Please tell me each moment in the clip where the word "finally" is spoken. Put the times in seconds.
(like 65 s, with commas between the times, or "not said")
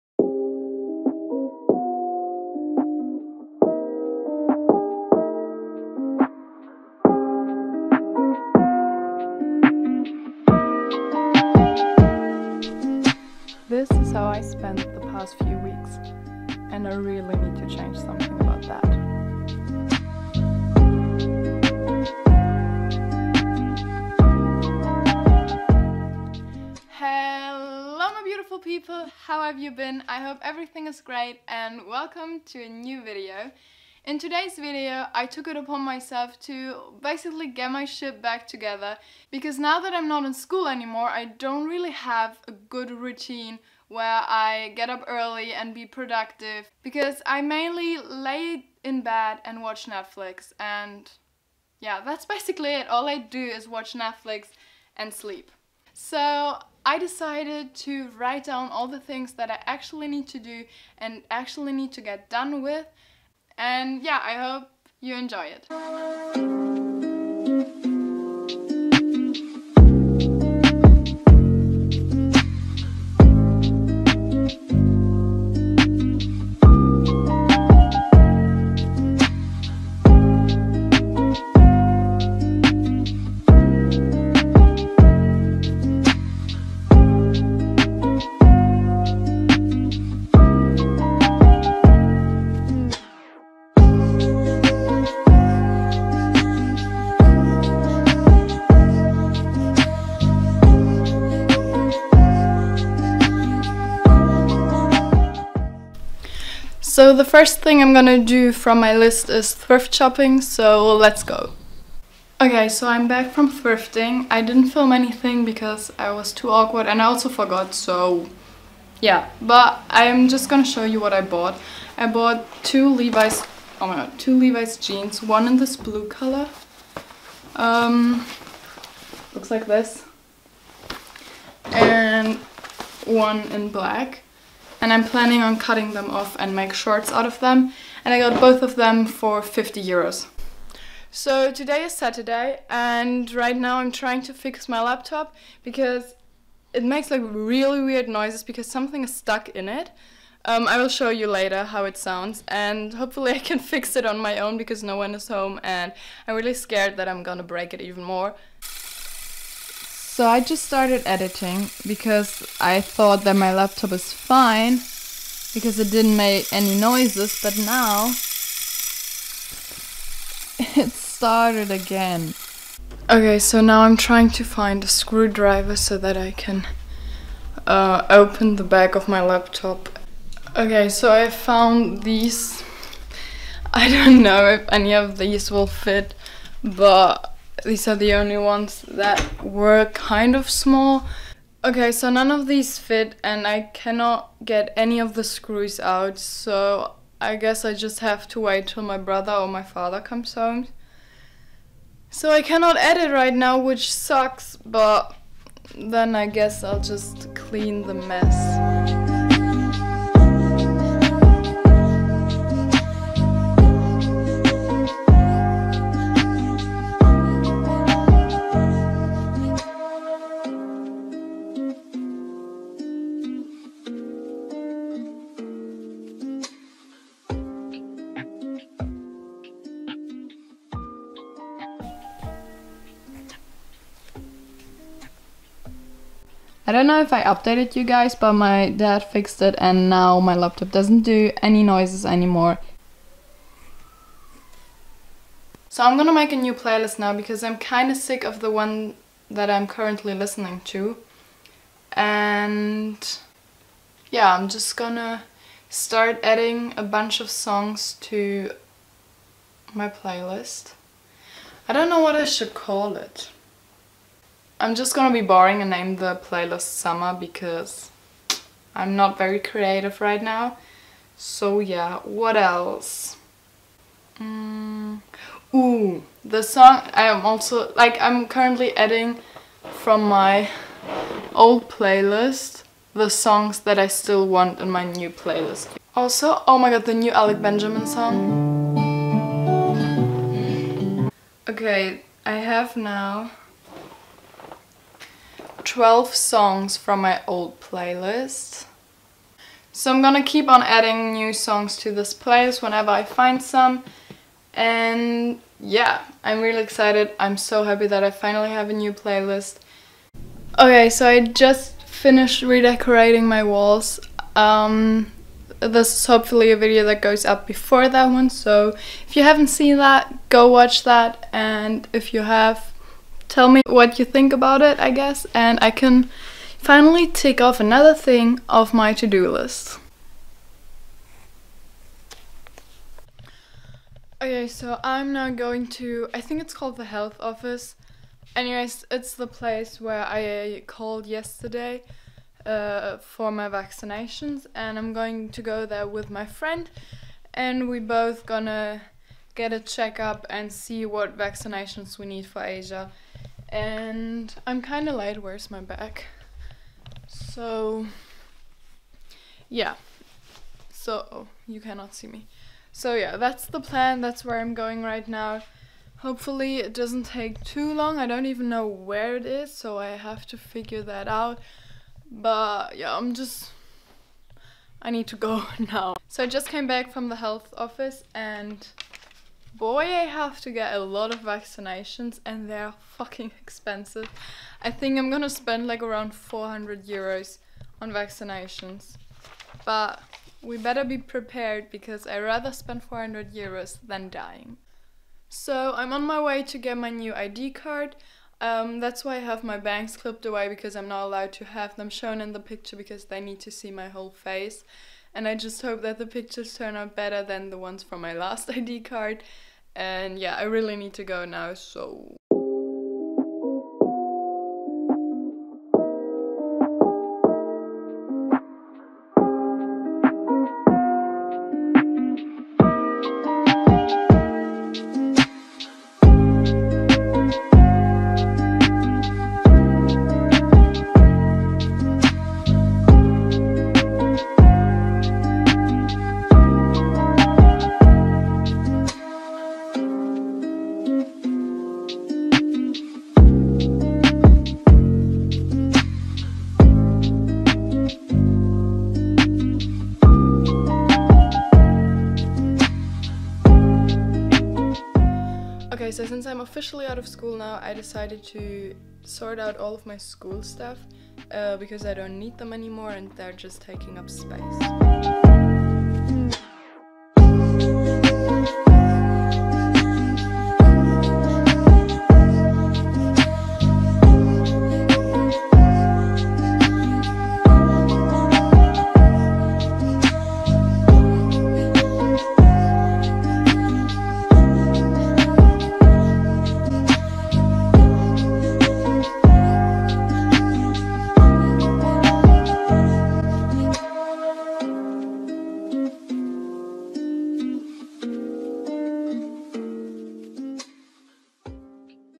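308 s, 326 s.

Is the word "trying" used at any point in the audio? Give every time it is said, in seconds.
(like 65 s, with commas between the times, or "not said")
143 s, 173 s.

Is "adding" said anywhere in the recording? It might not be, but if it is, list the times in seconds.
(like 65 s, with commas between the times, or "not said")
256 s, 278 s, 300 s.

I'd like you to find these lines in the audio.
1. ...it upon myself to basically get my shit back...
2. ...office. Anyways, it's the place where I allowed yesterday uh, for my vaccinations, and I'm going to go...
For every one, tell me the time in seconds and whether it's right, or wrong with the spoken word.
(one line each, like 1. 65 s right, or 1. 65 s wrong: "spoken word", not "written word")
1. 35 s right
2. 337 s wrong: "called", not "allowed".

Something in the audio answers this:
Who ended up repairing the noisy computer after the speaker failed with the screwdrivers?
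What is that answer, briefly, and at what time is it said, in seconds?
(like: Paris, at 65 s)
my dad, at 238 s.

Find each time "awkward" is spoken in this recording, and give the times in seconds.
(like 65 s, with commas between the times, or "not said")
116 s.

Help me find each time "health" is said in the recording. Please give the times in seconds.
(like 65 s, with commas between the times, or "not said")
336 s, 377 s.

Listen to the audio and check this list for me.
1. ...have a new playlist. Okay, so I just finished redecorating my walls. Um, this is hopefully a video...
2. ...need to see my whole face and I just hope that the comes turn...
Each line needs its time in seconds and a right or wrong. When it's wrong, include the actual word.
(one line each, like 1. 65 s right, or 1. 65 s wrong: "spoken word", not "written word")
1. 308 s right
2. 403 s wrong: "pictures", not "comes".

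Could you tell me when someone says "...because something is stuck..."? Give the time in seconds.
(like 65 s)
148 s.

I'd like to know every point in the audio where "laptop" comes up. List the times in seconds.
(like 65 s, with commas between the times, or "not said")
144 s, 163 s, 179 s, 240 s.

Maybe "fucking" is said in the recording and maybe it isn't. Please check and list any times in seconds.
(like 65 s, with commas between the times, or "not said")
382 s.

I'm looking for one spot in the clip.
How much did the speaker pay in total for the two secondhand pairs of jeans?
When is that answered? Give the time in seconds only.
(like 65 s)
139 s.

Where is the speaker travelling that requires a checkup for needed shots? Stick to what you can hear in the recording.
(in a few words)
Asia.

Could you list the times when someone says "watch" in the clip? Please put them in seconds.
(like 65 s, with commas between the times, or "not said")
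49 s, 53 s, 320 s.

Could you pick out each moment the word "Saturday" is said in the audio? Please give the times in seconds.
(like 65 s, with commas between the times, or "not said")
141 s.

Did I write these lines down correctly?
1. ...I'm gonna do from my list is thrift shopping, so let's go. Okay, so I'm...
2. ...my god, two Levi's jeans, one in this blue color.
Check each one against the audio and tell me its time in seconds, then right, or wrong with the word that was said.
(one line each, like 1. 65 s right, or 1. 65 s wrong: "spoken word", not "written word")
1. 107 s right
2. 123 s right.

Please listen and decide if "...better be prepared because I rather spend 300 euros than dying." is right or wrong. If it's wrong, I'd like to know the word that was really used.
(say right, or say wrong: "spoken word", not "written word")
wrong: "400", not "300".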